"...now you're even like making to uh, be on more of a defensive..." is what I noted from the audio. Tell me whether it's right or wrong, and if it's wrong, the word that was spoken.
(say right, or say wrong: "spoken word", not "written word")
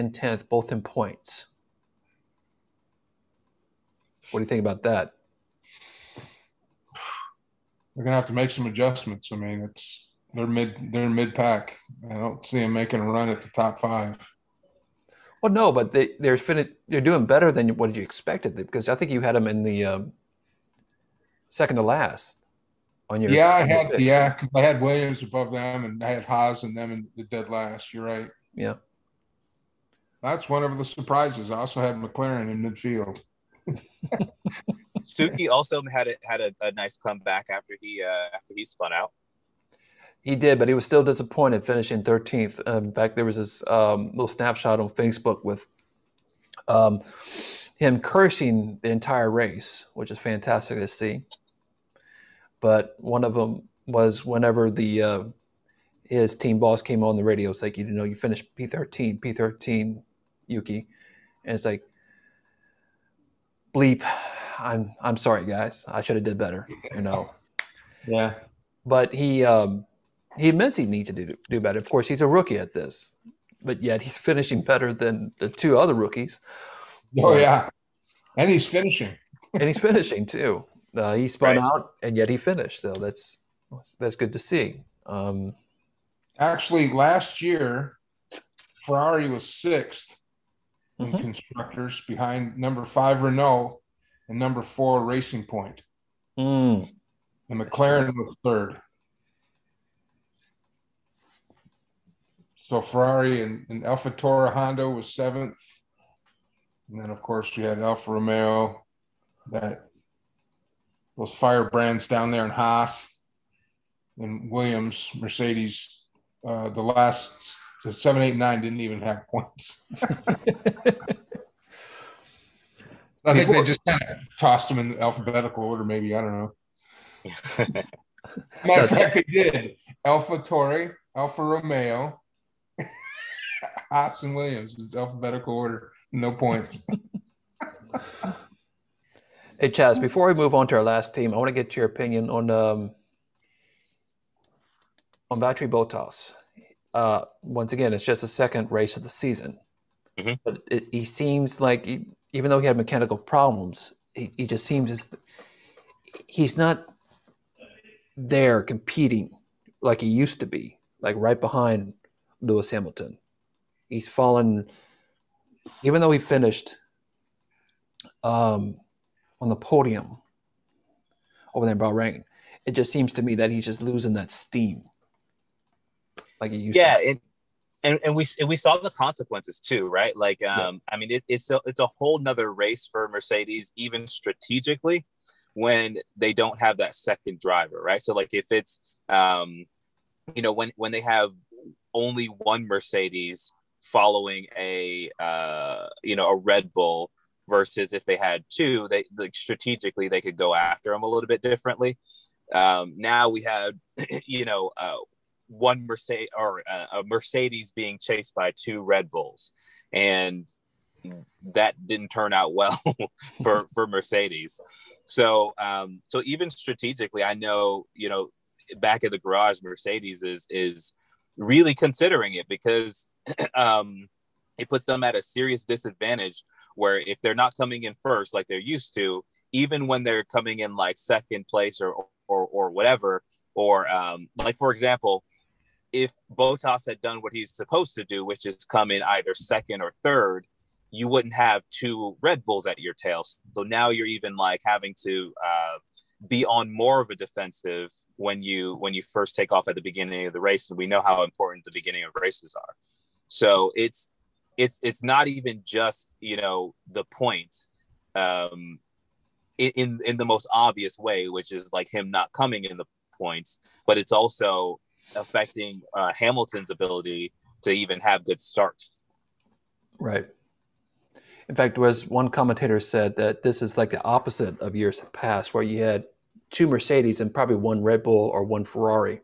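wrong: "having", not "making".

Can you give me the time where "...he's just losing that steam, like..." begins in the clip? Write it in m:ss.
2:53.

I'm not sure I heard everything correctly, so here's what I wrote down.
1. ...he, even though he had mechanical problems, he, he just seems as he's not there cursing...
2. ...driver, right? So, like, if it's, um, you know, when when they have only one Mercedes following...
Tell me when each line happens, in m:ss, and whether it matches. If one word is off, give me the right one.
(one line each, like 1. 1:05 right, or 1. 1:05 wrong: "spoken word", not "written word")
1. 2:31 wrong: "competing", not "cursing"
2. 3:07 right.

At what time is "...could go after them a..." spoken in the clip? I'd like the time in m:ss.
3:20.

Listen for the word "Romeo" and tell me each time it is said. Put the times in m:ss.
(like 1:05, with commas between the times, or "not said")
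1:48, 2:11.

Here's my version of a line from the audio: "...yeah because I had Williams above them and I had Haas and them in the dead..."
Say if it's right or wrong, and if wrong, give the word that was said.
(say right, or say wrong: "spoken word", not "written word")
right.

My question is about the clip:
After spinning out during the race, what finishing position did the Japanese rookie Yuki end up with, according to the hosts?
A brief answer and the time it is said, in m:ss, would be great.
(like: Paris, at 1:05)
13th, at 0:41.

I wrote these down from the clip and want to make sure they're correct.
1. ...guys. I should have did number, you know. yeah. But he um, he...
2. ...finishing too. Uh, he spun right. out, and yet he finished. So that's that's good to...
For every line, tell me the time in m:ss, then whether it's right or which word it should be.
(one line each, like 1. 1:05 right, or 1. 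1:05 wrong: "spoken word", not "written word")
1. 1:05 wrong: "better", not "number"
2. 1:19 right.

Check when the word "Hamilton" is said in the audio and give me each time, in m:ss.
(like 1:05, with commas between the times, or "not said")
2:42, 4:26.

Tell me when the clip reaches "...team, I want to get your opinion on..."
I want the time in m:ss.
2:21.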